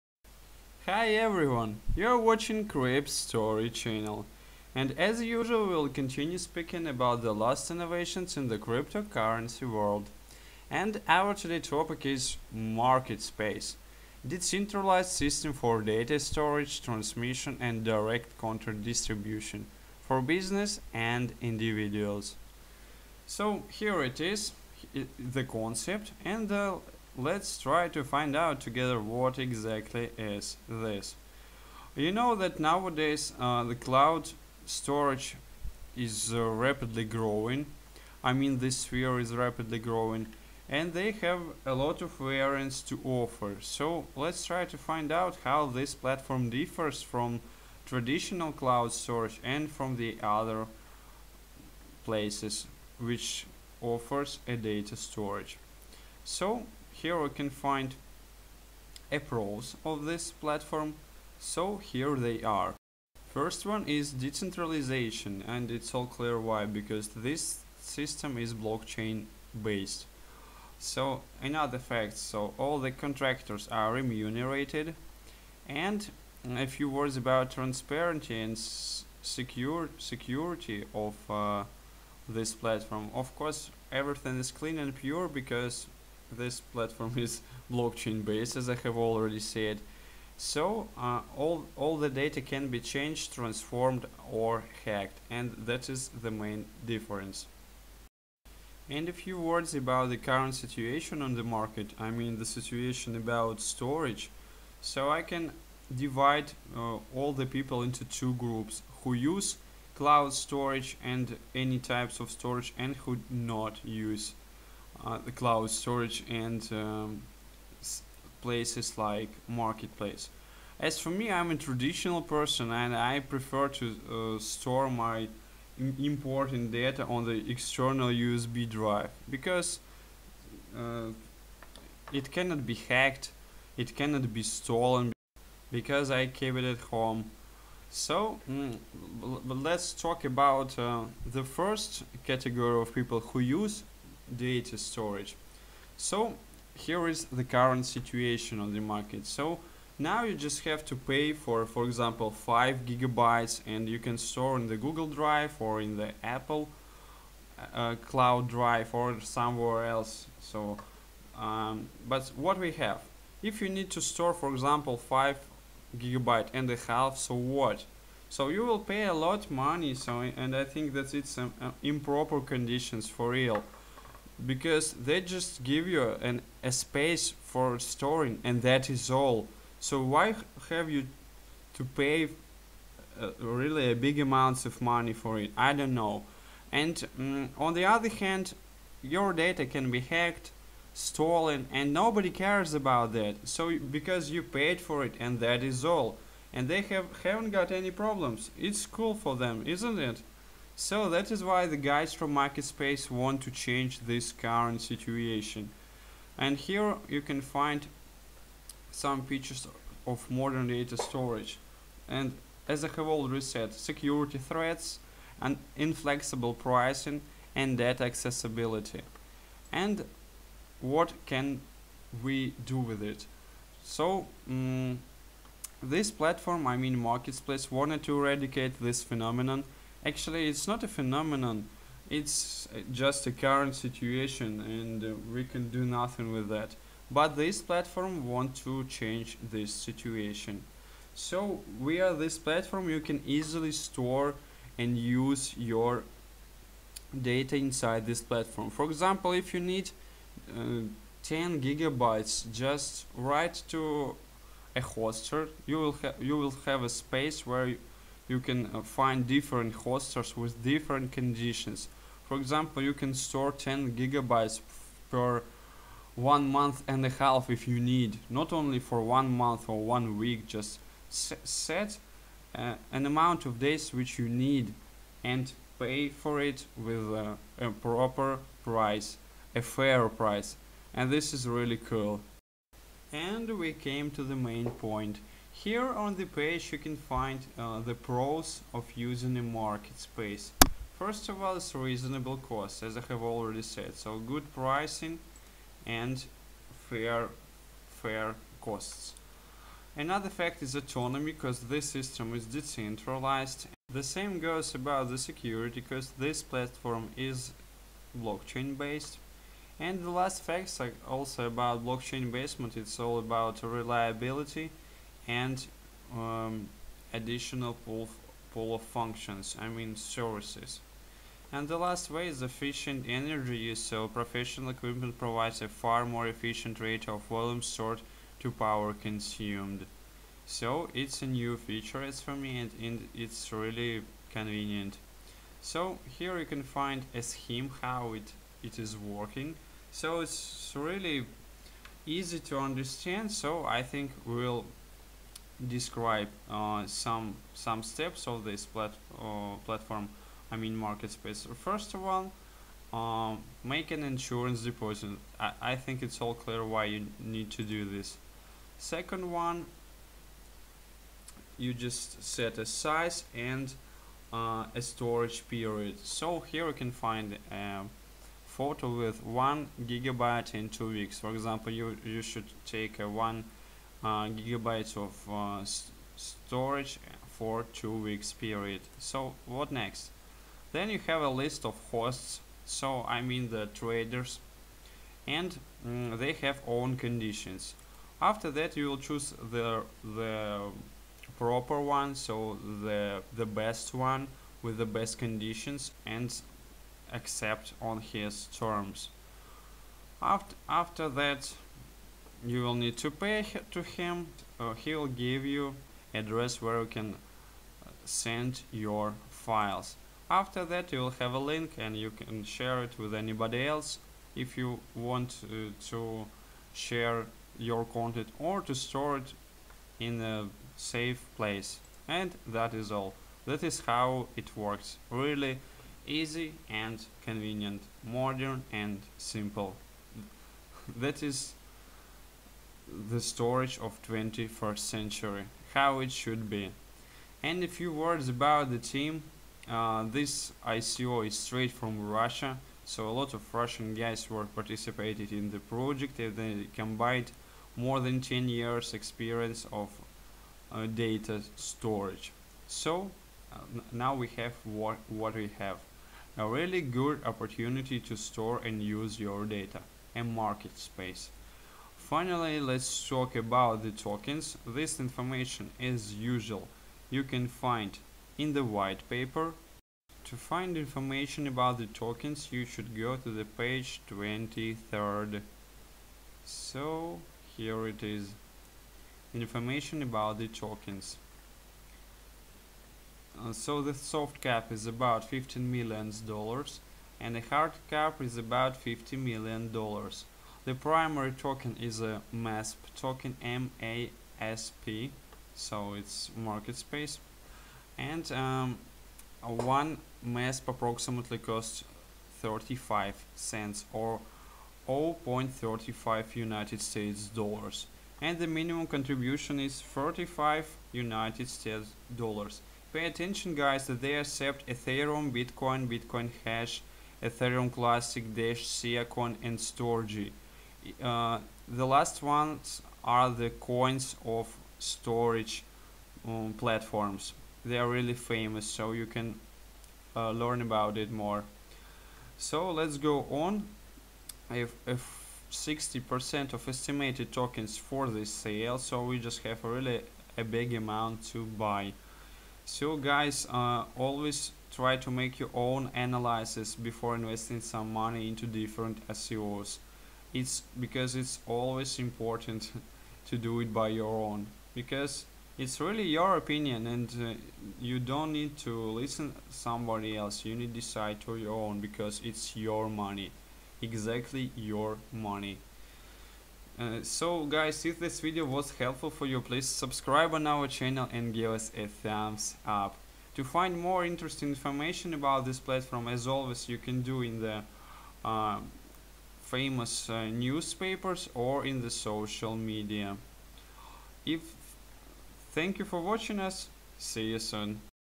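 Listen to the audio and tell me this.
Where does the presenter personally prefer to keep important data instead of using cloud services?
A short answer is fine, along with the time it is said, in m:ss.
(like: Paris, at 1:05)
External USB drive, at 2:07.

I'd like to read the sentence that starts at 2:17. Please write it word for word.
So mm, let's talk about uh, the first category of people who use data storage.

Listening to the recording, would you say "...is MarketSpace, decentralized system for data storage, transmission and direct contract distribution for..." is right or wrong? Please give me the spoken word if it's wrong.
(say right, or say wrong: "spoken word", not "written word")
right.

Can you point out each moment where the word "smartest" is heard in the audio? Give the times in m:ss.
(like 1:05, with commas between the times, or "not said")
not said.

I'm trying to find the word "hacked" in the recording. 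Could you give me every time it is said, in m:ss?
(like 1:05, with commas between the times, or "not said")
1:34, 2:12, 3:09.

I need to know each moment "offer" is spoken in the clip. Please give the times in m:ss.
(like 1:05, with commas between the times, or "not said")
0:43, 0:53.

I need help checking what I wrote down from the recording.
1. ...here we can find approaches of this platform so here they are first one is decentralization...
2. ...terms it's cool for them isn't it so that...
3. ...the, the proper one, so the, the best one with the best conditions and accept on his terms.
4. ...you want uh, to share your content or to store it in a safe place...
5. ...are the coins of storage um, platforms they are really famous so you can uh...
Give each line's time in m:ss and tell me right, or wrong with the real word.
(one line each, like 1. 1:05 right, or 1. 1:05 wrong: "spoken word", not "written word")
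1. 0:56 right
2. 3:17 wrong: "problems", not "terms"
3. 6:29 right
4. 6:54 right
5. 8:43 right.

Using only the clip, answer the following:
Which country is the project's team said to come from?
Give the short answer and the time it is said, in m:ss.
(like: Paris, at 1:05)
Russia, at 7:22.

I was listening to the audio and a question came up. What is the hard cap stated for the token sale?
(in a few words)
$50 million.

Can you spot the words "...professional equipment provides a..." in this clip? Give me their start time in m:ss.
5:24.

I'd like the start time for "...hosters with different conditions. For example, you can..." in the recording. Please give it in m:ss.
4:19.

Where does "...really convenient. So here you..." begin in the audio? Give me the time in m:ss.
5:33.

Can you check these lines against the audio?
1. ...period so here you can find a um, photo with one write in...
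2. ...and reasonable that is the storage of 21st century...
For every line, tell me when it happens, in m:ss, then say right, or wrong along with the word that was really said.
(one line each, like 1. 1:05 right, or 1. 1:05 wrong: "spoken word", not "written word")
1. 6:05 wrong: "gigabyte", not "write"
2. 7:08 wrong: "simple", not "reasonable".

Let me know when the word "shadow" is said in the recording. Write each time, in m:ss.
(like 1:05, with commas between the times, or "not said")
not said.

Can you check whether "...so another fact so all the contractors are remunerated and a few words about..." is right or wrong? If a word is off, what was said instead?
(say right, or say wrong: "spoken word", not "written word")
right.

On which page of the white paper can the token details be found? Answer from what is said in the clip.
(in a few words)
Page 23.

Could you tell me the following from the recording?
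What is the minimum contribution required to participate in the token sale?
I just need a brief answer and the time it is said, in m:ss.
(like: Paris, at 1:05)
$35, at 8:29.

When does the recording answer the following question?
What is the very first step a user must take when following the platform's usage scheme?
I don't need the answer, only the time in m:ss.
5:53.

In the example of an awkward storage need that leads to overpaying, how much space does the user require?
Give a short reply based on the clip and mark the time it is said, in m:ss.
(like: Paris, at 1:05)
5.5 gigabytes, at 2:44.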